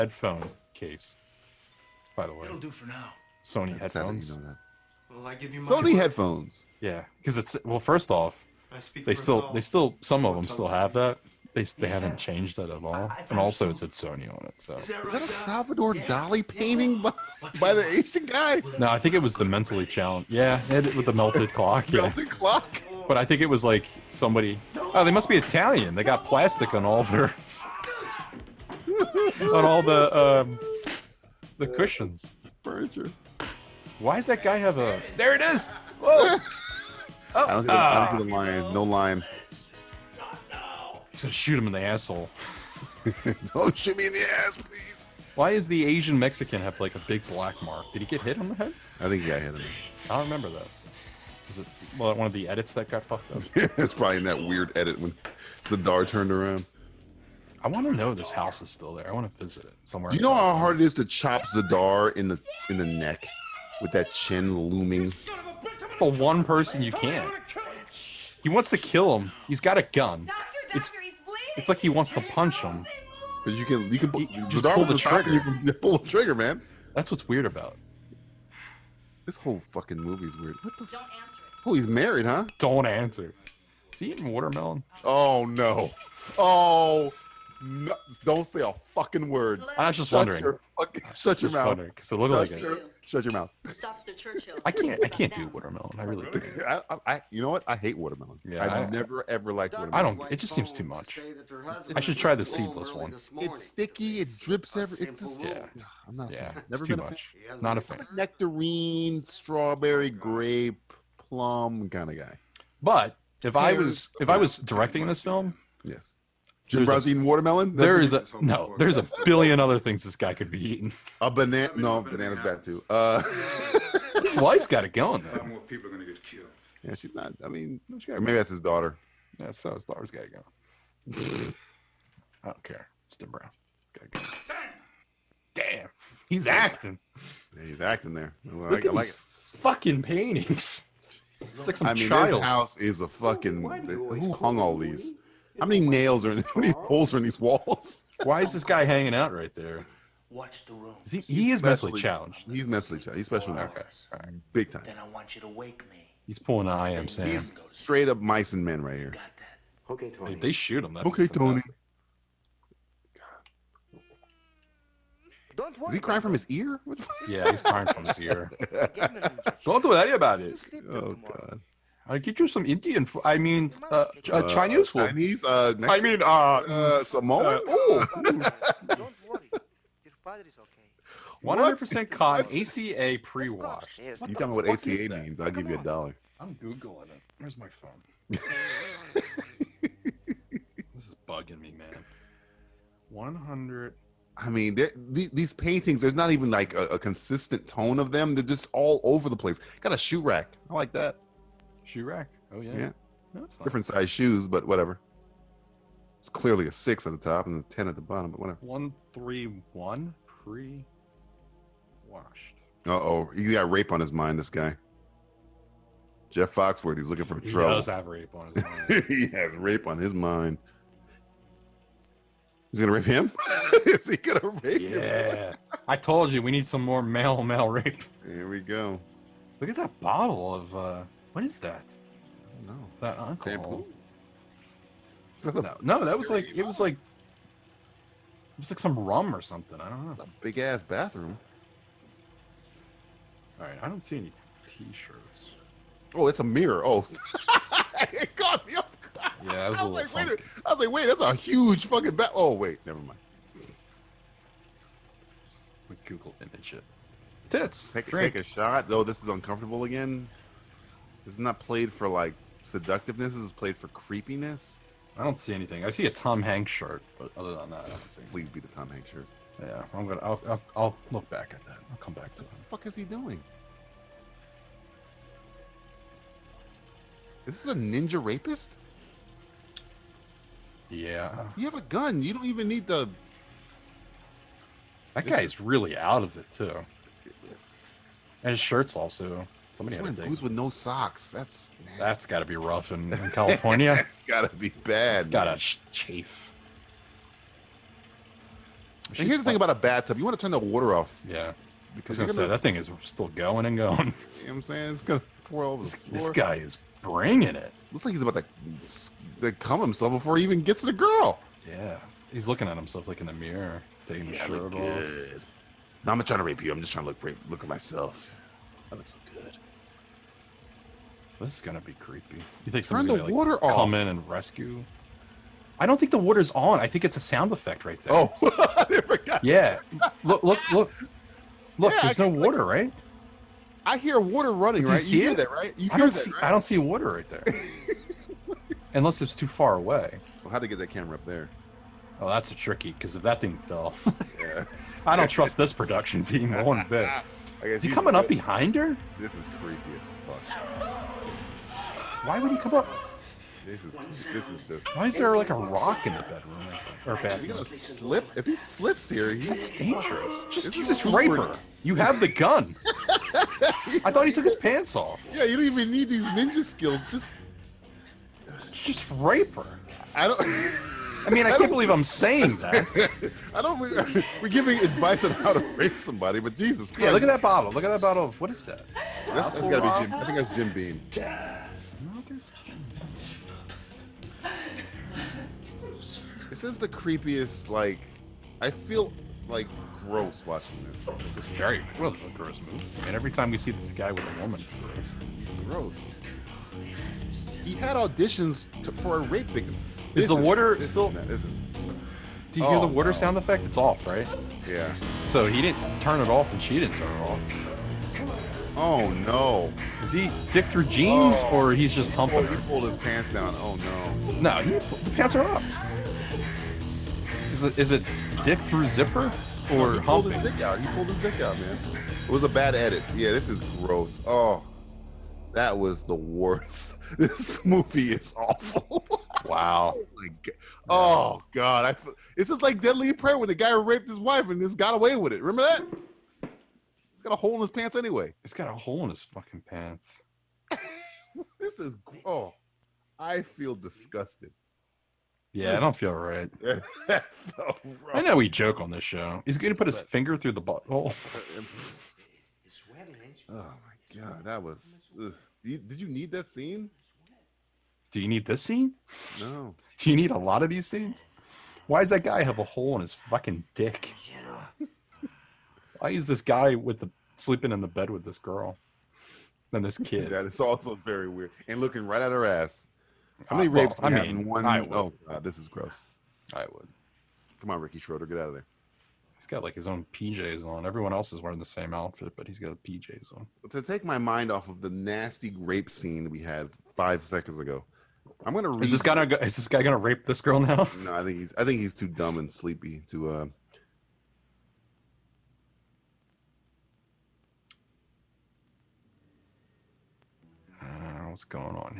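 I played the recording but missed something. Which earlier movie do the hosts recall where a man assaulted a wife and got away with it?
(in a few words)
Deadly Prey.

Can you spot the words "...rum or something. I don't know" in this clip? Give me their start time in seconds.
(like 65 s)
238 s.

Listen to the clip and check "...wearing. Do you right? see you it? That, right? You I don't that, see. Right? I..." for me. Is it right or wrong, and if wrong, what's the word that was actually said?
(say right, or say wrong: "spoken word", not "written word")
wrong: "running", not "wearing".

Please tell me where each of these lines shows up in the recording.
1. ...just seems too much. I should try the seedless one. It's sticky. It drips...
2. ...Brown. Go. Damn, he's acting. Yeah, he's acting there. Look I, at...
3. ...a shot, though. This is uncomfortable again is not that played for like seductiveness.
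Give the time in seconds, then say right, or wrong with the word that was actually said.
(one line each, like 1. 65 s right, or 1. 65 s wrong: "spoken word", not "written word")
1. 100 s right
2. 133 s right
3. 258 s right.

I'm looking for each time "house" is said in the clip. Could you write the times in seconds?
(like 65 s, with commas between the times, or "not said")
58 s, 142 s.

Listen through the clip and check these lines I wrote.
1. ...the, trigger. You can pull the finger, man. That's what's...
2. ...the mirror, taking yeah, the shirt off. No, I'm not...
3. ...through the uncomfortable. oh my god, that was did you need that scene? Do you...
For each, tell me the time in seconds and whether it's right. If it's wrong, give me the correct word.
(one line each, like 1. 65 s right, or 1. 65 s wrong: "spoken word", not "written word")
1. 74 s wrong: "trigger", not "finger"
2. 313 s right
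3. 450 s wrong: "butthole", not "uncomfortable".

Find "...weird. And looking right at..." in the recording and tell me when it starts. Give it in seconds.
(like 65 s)
471 s.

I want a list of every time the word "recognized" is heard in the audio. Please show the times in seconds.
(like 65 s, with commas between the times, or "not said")
not said.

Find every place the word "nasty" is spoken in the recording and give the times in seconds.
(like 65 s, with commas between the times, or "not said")
291 s, 484 s.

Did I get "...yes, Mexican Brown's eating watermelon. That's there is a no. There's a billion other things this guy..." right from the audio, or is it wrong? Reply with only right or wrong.
wrong.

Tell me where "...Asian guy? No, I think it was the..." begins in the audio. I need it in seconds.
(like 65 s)
17 s.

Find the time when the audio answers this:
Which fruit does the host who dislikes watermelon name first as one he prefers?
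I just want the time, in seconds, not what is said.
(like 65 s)
108 s.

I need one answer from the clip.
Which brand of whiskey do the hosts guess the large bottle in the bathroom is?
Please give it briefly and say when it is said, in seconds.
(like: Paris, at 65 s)
Jim Beam, at 380 s.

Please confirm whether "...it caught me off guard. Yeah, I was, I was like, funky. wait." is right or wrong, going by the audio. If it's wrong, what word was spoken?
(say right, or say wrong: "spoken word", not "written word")
right.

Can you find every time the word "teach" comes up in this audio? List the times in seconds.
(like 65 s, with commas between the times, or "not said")
not said.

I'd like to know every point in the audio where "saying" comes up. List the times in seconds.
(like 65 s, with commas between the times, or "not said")
304 s, 372 s.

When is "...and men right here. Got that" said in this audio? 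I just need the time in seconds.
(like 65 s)
158 s.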